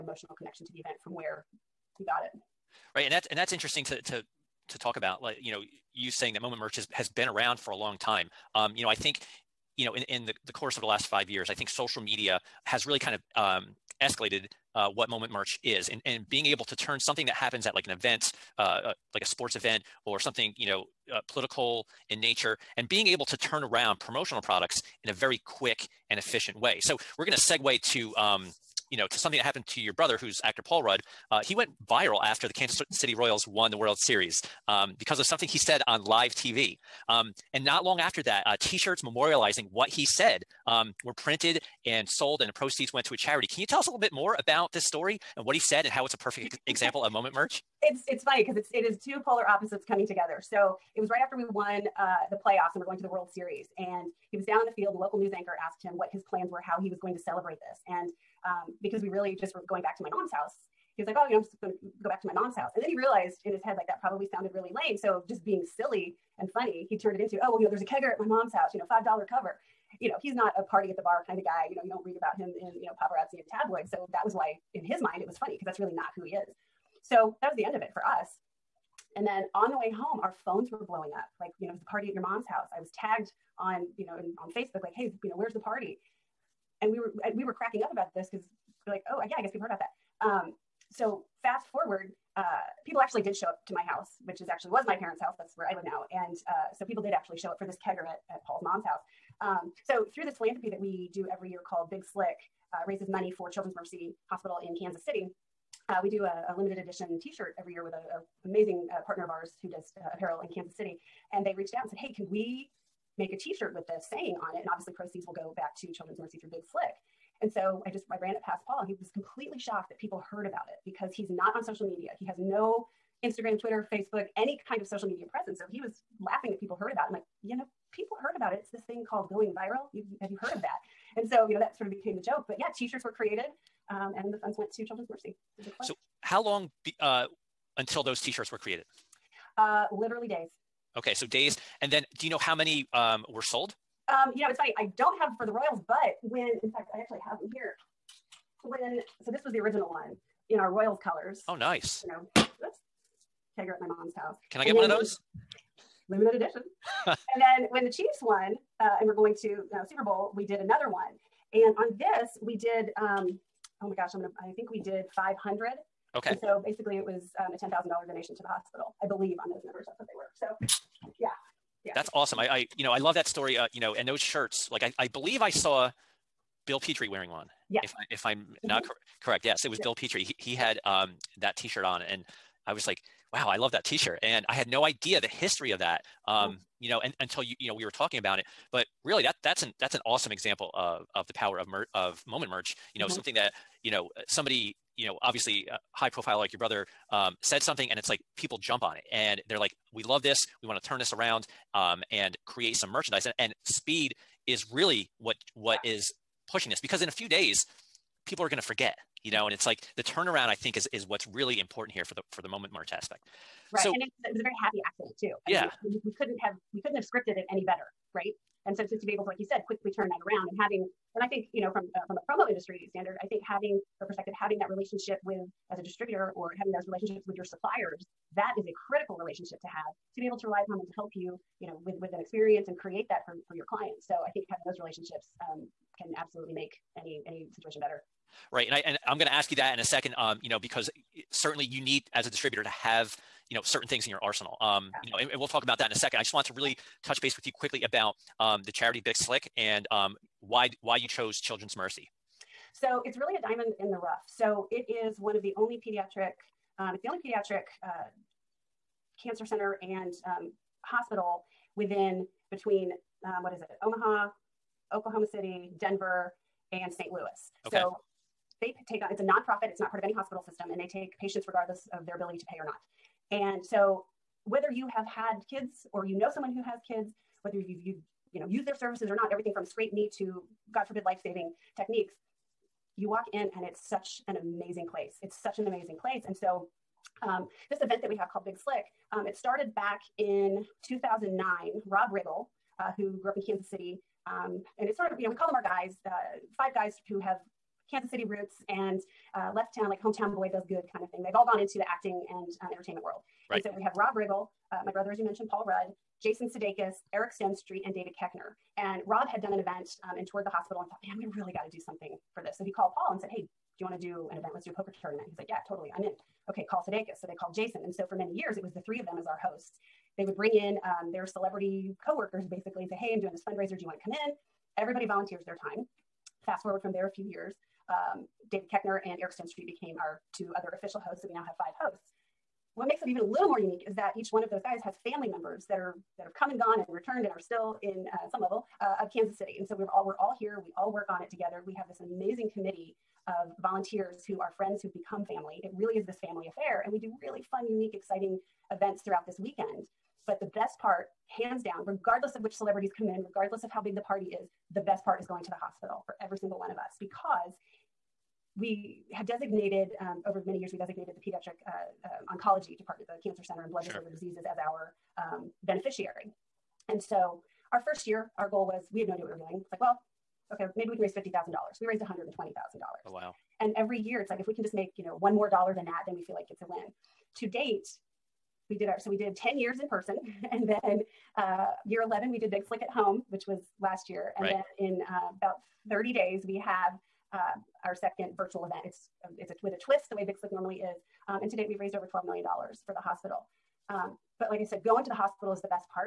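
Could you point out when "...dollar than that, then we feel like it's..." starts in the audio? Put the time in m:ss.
6:15.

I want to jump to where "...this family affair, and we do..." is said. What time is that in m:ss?
5:46.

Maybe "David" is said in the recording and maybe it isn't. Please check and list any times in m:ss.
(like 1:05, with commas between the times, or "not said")
5:07, 5:28.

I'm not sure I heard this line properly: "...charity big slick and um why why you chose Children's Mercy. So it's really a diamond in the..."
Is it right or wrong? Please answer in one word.
right.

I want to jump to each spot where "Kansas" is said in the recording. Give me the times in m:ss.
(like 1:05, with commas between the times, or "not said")
0:32, 1:44, 1:50, 4:53, 4:57, 5:39.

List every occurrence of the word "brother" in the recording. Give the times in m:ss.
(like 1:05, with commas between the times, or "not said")
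0:29, 3:16, 5:04.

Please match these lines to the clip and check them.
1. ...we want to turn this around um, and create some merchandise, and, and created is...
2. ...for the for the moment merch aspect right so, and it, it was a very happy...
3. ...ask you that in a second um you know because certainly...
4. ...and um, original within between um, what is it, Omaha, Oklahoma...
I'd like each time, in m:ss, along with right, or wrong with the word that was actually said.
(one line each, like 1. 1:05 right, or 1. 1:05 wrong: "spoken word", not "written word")
1. 3:20 wrong: "speed", not "created"
2. 3:32 right
3. 3:59 right
4. 4:19 wrong: "hospital", not "original".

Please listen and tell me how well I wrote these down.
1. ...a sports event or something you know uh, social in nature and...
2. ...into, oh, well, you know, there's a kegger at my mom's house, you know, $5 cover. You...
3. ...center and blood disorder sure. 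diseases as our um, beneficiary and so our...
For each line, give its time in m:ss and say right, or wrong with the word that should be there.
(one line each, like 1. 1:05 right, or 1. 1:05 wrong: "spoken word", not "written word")
1. 0:19 wrong: "political", not "social"
2. 1:07 right
3. 6:03 right.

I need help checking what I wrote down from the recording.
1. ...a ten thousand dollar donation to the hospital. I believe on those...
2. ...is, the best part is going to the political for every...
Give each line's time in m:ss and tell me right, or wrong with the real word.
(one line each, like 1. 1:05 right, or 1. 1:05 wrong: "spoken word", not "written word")
1. 2:47 right
2. 5:54 wrong: "hospital", not "political".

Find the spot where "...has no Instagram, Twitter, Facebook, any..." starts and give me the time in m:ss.
2:02.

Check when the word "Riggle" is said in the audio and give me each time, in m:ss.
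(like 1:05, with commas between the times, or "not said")
4:52, 5:04.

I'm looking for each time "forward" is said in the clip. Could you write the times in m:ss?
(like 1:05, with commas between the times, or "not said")
1:31, 5:26.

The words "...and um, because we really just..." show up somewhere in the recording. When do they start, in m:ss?
0:57.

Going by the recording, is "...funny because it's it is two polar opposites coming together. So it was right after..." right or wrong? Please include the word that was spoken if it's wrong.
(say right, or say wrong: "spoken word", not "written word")
right.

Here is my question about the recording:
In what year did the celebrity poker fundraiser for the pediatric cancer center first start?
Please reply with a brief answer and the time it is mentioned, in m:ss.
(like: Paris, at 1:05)
2009, at 4:50.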